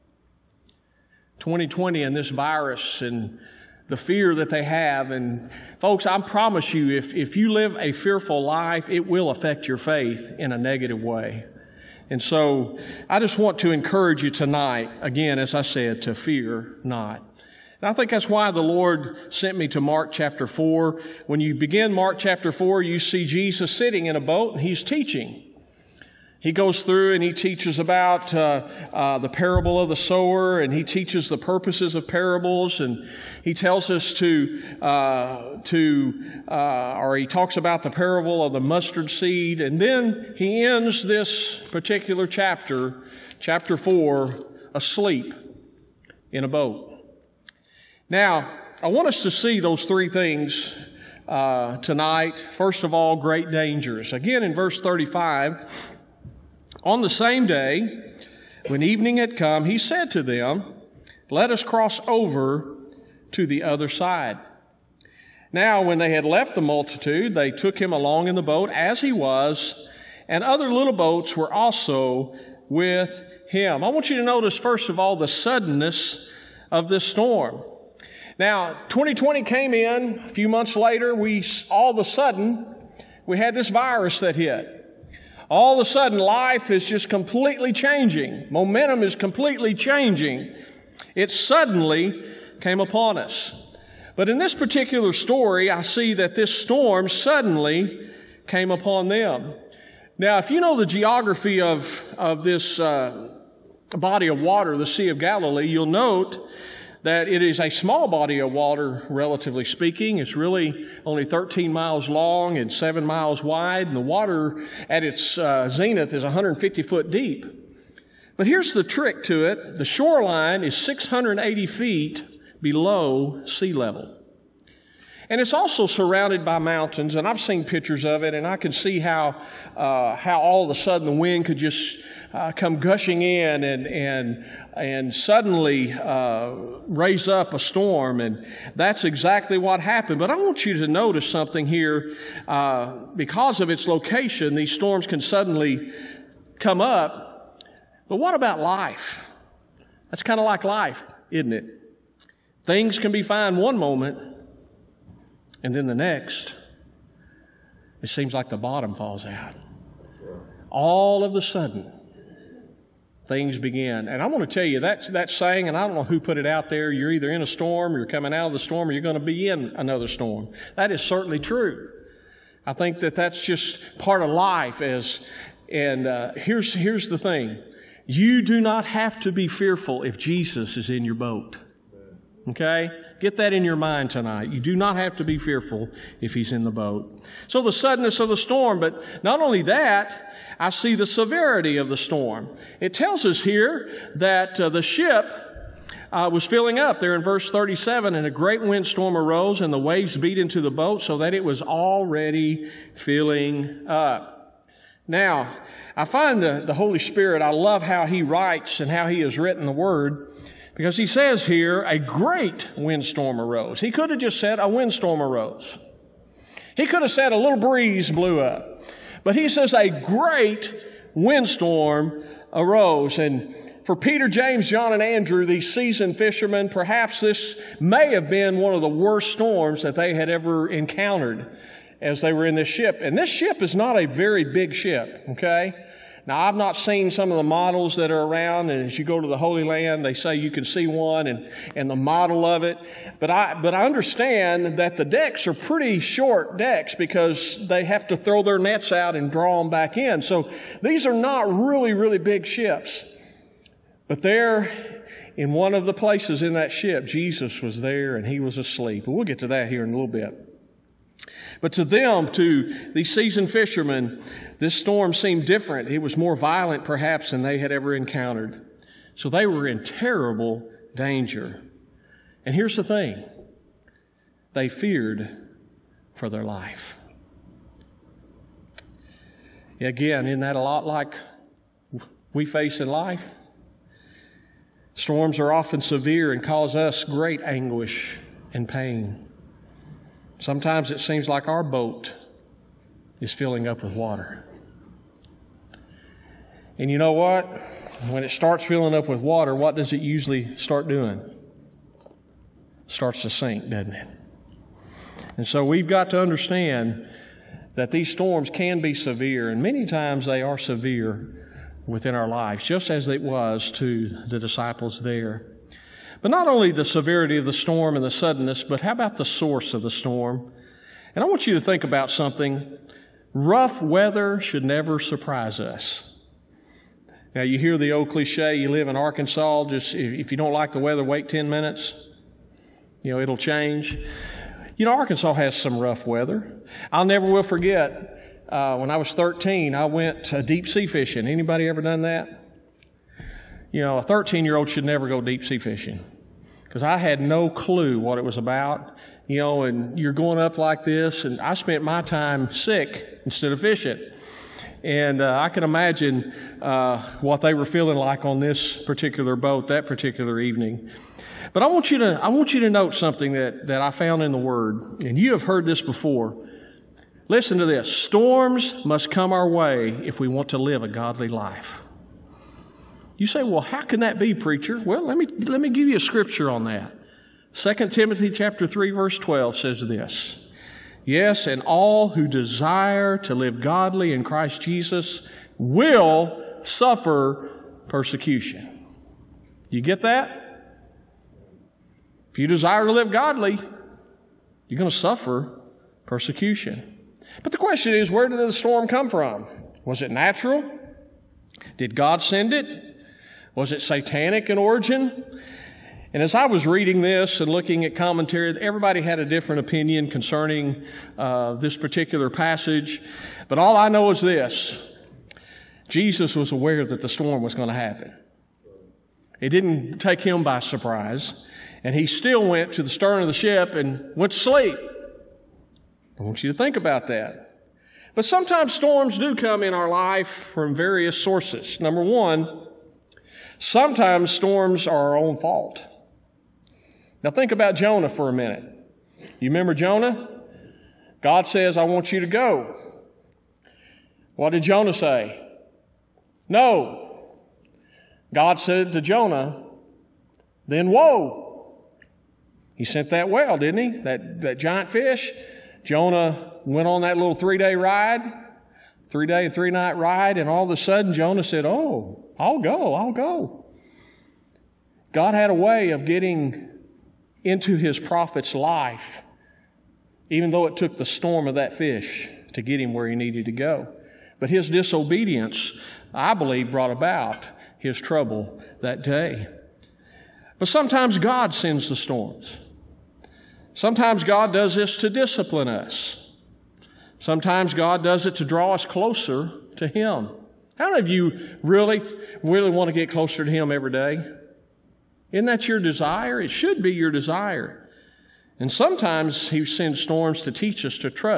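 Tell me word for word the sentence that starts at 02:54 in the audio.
As and uh, here's here's the thing: you do not have to be fearful if Jesus is in your boat.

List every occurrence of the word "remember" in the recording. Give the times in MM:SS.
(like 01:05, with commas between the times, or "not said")
07:19.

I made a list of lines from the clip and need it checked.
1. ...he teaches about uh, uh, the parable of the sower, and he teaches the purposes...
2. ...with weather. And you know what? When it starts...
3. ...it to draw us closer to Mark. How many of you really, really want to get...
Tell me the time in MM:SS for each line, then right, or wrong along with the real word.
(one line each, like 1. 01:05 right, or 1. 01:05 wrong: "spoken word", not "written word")
1. 00:27 right
2. 04:53 wrong: "water", not "weather"
3. 08:08 wrong: "Him", not "Mark".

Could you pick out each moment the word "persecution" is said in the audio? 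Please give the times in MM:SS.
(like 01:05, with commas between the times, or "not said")
06:27, 06:36.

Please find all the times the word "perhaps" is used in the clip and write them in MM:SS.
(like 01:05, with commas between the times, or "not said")
03:46, 04:26.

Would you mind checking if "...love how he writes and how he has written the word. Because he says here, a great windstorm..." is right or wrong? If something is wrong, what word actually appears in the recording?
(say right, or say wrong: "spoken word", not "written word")
right.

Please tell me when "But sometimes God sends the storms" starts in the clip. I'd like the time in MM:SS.
08:00.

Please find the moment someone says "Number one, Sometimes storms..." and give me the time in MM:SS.
07:11.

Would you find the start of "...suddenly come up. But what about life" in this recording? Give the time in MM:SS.
02:25.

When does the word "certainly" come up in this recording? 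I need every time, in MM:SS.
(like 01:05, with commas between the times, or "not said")
02:51.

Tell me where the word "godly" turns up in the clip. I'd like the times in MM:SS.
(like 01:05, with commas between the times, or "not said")
06:10, 06:23, 06:33.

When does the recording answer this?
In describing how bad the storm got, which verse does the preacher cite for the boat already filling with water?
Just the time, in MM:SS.
03:17.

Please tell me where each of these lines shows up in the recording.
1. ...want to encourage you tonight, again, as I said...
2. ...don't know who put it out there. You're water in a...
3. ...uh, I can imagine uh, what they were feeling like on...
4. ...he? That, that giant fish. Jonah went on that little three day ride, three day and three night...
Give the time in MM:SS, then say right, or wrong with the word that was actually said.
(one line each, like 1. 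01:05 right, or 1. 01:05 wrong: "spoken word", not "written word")
1. 00:13 right
2. 02:45 wrong: "either", not "water"
3. 05:55 right
4. 07:33 right.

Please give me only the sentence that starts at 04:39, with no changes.
Again, isn't that a lot like we face in life?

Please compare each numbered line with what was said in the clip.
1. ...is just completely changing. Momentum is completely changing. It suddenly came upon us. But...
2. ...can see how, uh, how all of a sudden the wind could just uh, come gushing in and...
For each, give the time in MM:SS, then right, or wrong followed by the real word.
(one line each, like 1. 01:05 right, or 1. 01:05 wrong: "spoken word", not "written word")
1. 01:26 right
2. 02:08 right.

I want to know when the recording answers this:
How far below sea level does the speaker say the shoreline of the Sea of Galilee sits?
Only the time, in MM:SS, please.
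02:00.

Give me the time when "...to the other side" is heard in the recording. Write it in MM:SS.
01:03.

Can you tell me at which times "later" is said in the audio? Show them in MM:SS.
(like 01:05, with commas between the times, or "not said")
01:20.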